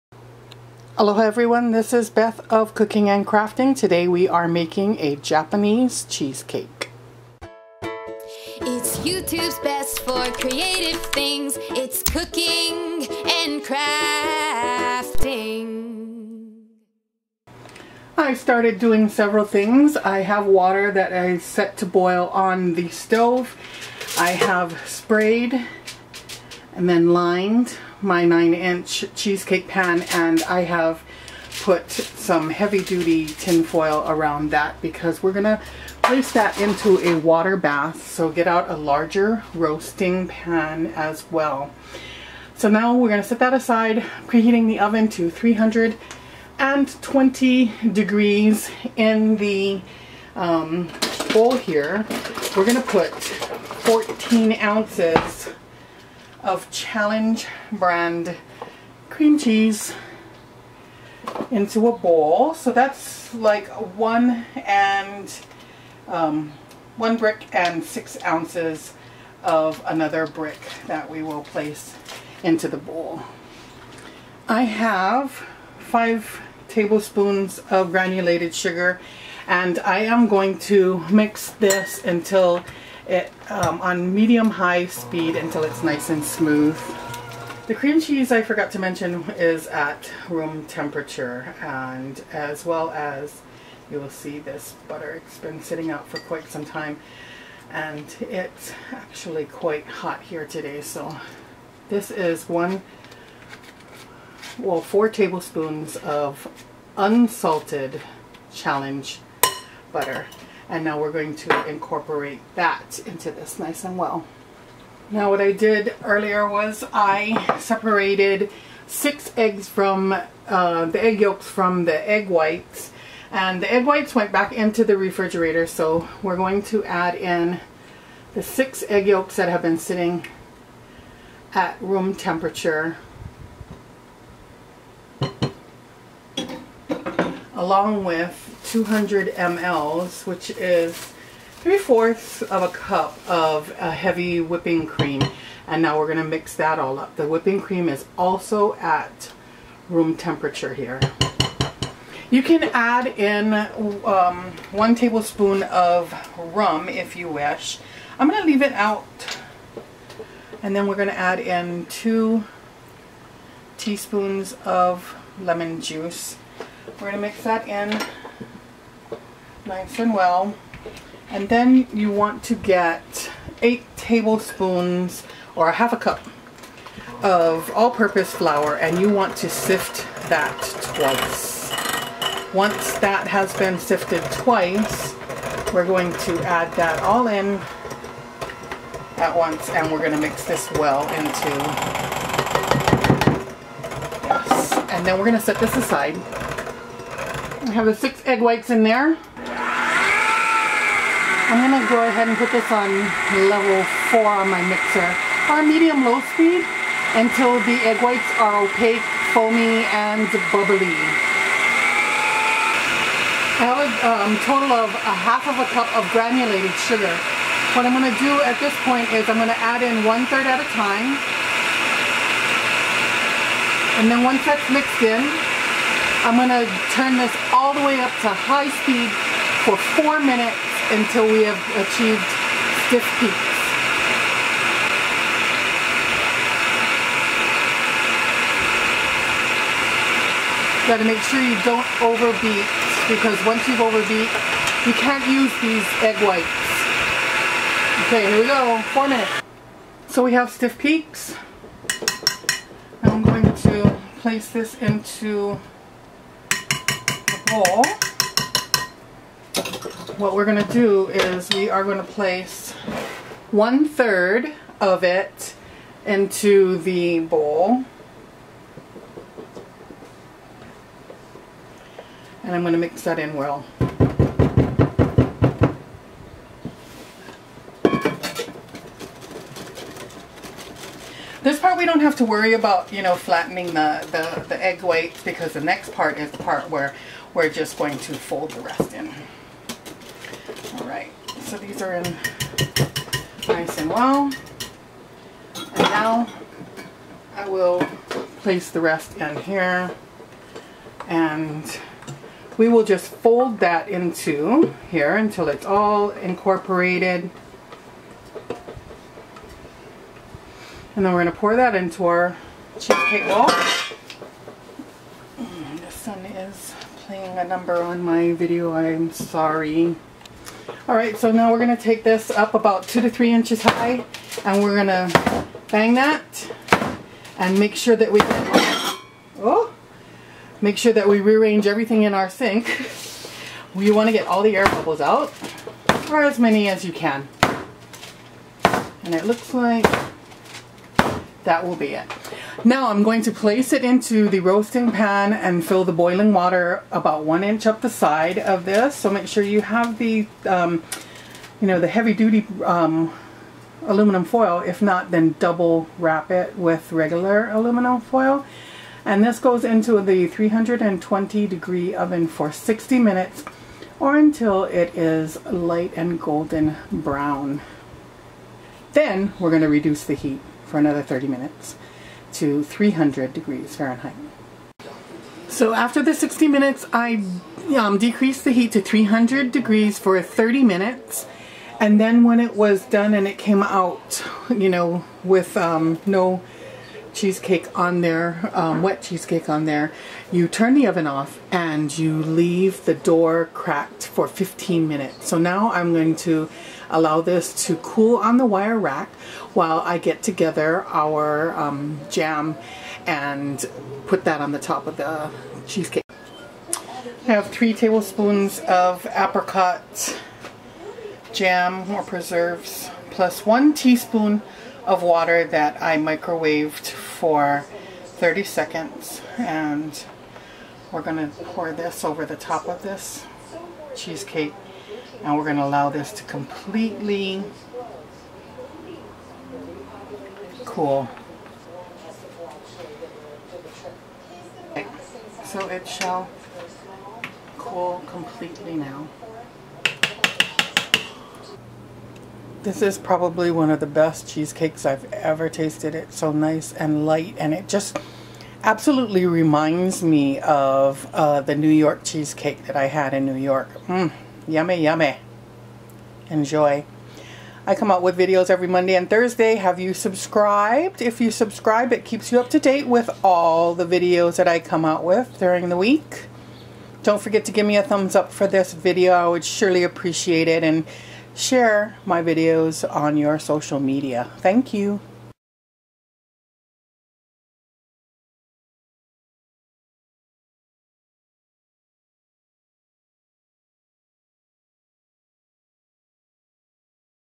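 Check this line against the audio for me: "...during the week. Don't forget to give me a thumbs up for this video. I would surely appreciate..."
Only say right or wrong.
right.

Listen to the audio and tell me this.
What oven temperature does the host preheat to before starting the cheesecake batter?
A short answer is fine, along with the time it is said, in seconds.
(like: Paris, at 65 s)
320 degrees, at 45 s.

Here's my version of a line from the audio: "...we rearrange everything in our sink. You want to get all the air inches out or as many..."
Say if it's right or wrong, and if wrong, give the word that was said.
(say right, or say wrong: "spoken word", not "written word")
wrong: "bubbles", not "inches".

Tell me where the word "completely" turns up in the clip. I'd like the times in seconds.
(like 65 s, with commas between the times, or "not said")
426 s, 438 s.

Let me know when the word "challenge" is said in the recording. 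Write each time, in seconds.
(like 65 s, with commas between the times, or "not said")
56 s, 108 s.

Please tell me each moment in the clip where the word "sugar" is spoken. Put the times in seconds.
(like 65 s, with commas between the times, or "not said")
78 s, 216 s.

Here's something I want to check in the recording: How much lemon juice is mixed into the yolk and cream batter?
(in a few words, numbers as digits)
2 teaspoons.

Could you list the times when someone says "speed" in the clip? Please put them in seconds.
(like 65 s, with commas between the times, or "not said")
84 s, 206 s, 228 s.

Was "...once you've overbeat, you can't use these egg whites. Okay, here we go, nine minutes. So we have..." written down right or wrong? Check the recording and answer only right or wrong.
wrong.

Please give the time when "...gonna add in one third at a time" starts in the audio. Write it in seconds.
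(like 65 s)
219 s.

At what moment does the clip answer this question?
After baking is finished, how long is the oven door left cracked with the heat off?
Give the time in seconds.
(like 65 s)
394 s.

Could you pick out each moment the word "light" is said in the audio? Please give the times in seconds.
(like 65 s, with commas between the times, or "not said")
365 s, 447 s.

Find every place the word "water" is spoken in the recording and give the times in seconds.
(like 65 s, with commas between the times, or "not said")
20 s, 37 s, 346 s, 415 s.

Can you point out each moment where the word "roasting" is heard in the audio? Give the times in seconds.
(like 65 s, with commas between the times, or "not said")
39 s, 344 s.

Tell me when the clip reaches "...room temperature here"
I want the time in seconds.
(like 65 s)
149 s.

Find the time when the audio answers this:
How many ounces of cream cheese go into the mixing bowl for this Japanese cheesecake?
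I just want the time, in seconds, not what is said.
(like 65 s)
53 s.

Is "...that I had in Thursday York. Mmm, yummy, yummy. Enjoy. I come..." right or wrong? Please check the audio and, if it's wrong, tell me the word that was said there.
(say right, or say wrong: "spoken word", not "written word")
wrong: "New", not "Thursday".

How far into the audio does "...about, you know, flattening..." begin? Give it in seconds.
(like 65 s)
282 s.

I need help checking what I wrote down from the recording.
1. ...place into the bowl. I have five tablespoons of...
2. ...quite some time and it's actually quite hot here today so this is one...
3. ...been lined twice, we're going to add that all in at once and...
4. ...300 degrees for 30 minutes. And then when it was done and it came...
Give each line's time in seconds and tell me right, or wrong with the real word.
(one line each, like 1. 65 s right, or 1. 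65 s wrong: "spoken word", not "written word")
1. 71 s right
2. 96 s right
3. 183 s wrong: "sifted", not "lined"
4. 378 s right.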